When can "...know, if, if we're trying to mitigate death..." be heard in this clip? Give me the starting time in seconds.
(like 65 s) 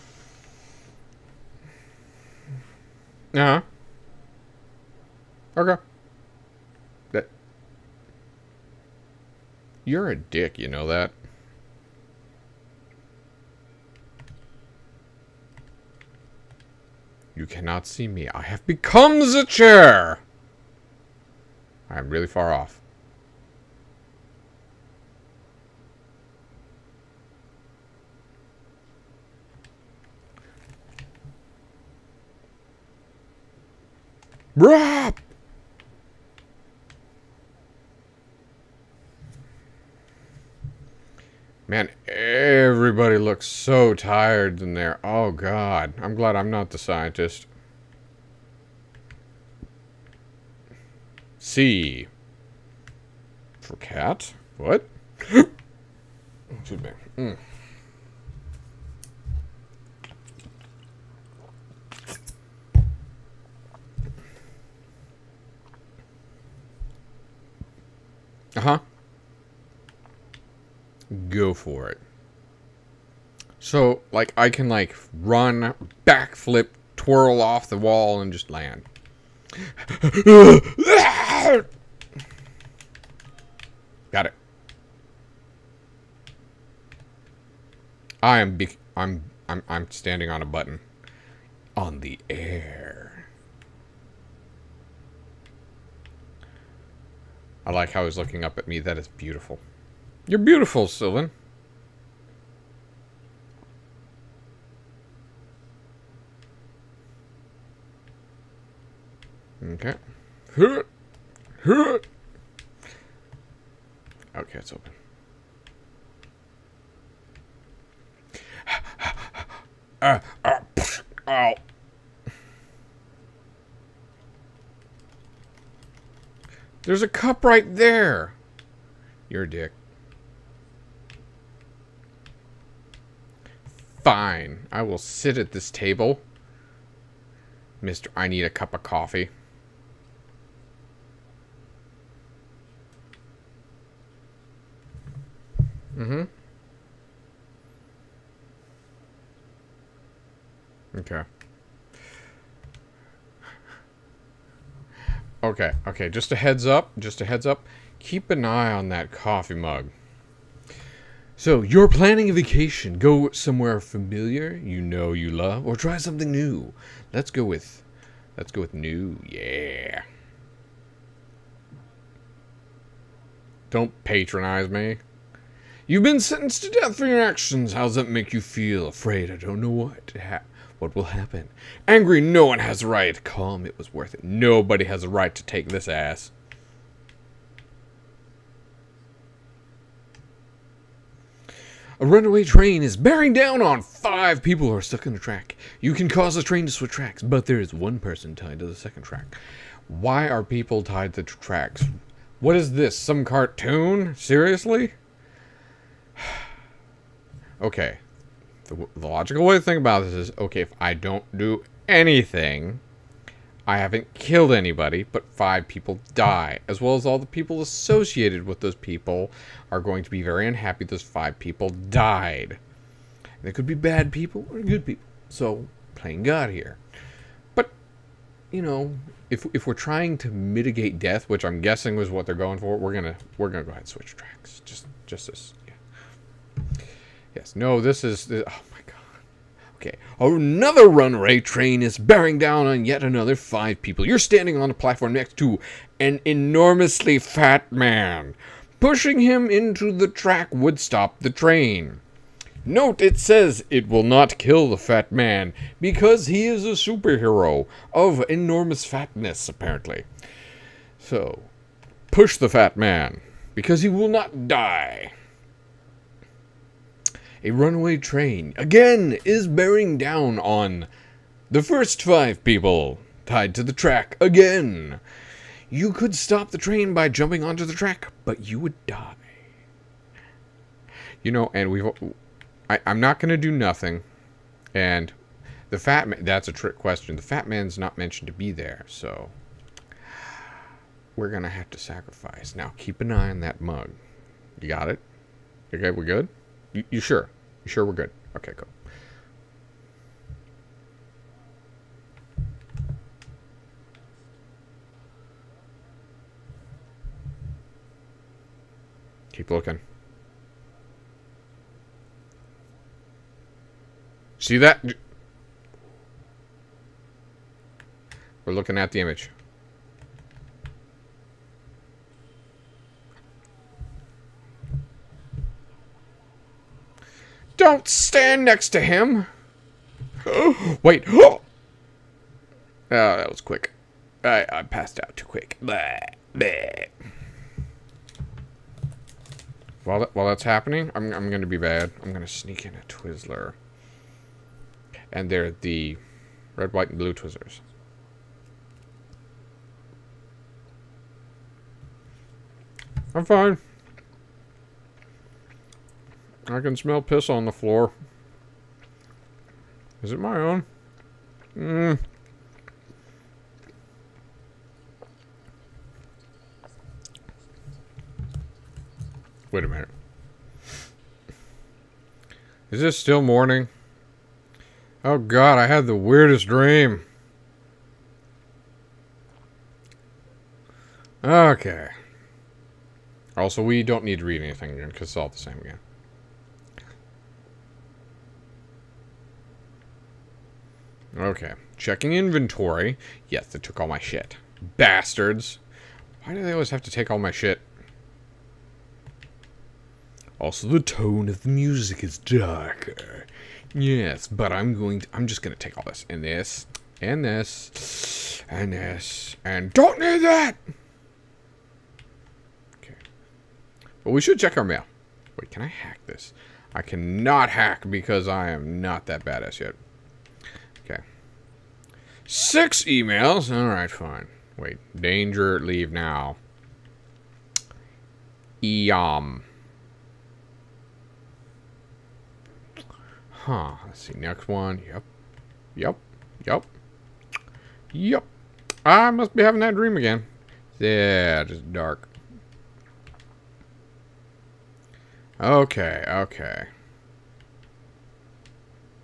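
228 s.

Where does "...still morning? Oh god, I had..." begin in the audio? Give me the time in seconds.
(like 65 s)
372 s.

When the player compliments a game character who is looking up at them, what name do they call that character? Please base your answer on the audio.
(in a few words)
Sylvan.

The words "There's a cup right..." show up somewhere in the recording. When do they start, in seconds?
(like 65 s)
126 s.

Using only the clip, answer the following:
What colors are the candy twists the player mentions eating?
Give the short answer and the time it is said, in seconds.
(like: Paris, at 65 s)
red, white, and blue, at 346 s.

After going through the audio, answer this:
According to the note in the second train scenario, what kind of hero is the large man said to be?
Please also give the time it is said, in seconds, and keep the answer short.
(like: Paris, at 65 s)
superhero, at 256 s.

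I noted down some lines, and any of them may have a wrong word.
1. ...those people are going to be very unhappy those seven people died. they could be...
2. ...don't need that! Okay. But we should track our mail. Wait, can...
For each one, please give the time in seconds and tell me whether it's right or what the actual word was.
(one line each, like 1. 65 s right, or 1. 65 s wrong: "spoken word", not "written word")
1. 218 s wrong: "five", not "seven"
2. 409 s wrong: "check", not "track".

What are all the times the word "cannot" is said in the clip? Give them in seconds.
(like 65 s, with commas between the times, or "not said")
17 s, 416 s.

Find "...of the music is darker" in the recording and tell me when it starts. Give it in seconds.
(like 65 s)
401 s.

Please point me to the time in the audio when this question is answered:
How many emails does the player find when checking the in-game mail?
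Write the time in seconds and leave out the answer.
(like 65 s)
422 s.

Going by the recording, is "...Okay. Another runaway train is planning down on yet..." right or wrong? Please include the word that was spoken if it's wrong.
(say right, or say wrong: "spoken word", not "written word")
wrong: "bearing", not "planning".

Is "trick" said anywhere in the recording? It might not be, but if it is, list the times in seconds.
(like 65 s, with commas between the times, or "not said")
286 s.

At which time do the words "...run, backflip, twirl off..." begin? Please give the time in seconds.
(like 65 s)
75 s.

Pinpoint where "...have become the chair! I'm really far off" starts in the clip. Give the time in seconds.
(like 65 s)
18 s.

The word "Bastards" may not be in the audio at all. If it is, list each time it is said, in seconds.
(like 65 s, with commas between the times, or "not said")
394 s.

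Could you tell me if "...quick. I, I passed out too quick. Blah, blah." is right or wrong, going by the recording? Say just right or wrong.
right.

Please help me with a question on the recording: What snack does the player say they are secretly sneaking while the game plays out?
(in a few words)
Twizzler.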